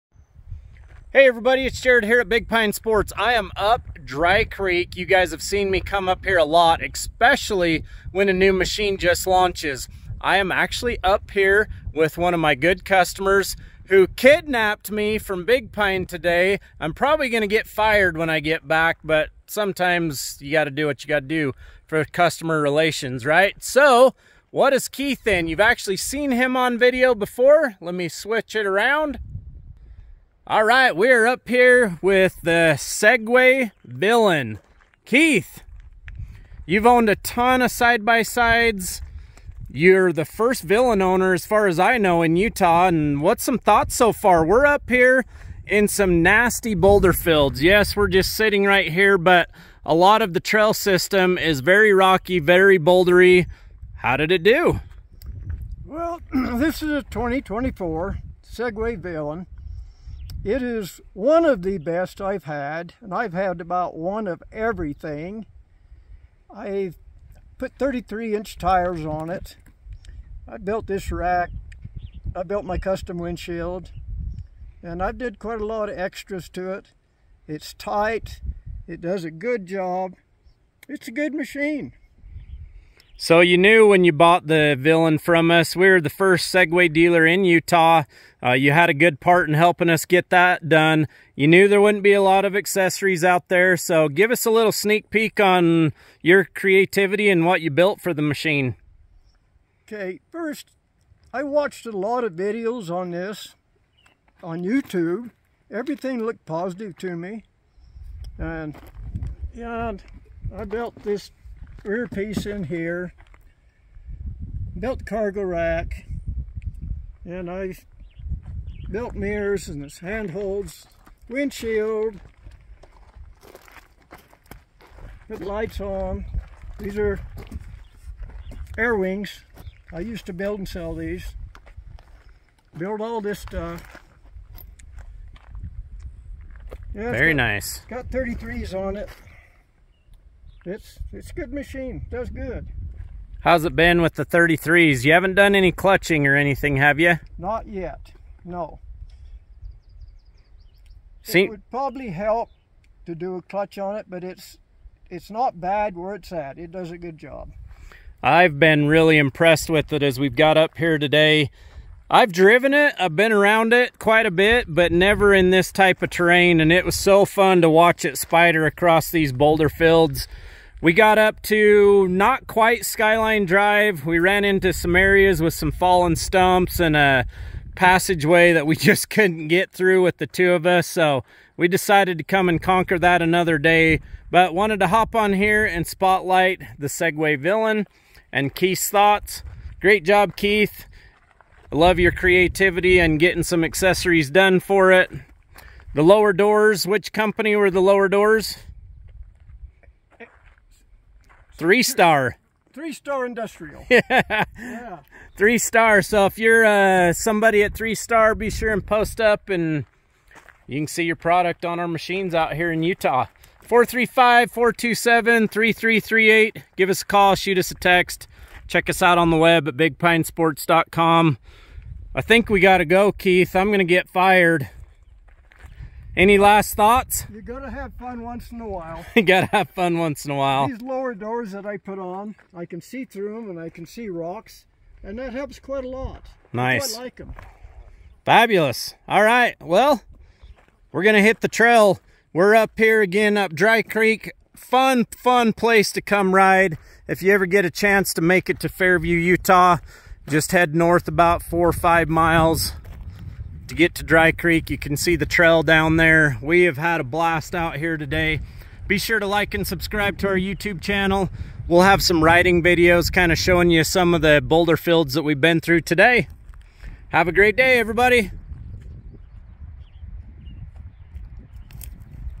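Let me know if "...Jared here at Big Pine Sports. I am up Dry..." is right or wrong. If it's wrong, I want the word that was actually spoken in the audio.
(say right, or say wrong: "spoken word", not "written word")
right.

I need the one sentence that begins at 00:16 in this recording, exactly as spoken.
I'm probably gonna get fired when I get back, but sometimes you gotta do what you gotta do for customer relations, right?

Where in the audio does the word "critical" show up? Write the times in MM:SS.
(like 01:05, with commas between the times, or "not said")
not said.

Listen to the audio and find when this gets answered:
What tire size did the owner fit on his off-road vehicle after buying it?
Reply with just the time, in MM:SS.
01:07.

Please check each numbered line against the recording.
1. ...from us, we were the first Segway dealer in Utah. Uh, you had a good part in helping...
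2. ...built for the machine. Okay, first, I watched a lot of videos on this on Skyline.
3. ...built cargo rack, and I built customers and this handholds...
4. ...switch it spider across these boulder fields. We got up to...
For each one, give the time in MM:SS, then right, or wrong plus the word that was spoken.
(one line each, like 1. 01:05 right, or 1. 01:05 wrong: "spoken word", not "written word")
1. 01:25 right
2. 01:37 wrong: "YouTube", not "Skyline"
3. 01:54 wrong: "mirrors", not "customers"
4. 02:47 wrong: "watch", not "switch".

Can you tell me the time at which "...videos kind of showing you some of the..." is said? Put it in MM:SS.
04:22.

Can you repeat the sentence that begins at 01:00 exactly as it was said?
It is one of the best I've had, and I've had about one of everything.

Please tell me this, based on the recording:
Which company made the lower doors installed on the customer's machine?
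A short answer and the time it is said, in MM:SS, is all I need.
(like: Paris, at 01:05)
Three Star Industrial, at 03:22.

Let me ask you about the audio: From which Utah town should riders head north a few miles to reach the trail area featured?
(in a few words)
Fairview.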